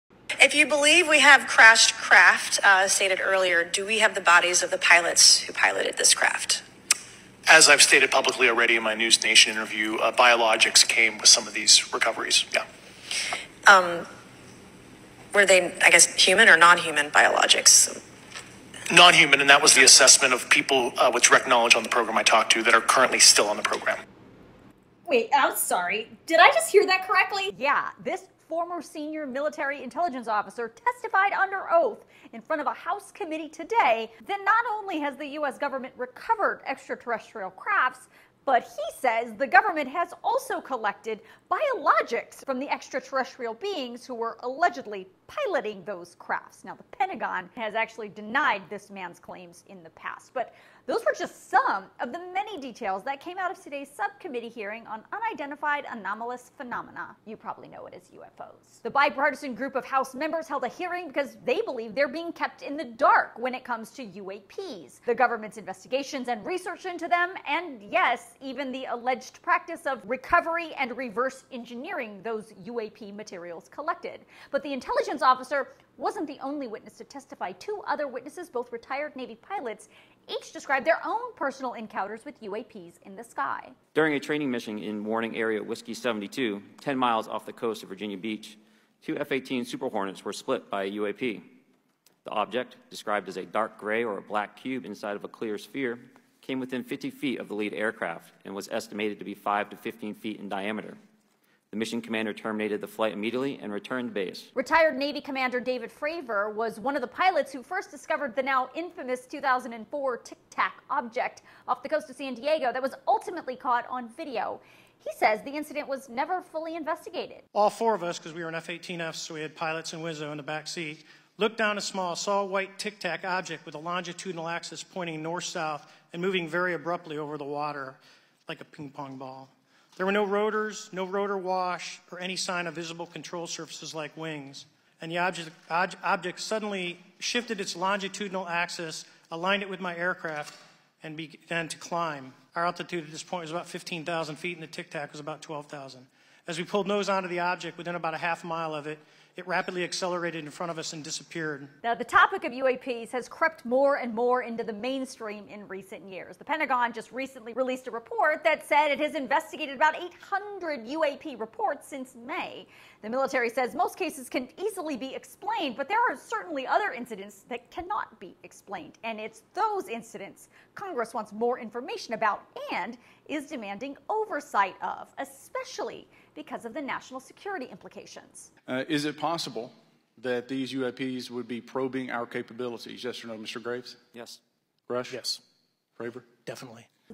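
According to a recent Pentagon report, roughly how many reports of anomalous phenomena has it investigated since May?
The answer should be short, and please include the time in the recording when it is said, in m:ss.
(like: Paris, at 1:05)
800, at 2:39.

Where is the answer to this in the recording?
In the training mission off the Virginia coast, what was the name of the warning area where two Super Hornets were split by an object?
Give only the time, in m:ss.
1:25.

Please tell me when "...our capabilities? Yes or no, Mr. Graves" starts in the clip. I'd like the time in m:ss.
3:02.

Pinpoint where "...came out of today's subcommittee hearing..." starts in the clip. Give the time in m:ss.
0:53.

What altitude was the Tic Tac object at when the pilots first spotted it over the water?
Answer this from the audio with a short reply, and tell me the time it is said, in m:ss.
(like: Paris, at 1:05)
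12,000 feet, at 2:25.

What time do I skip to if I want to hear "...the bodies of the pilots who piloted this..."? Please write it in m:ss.
0:04.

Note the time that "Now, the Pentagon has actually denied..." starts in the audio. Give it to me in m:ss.
0:46.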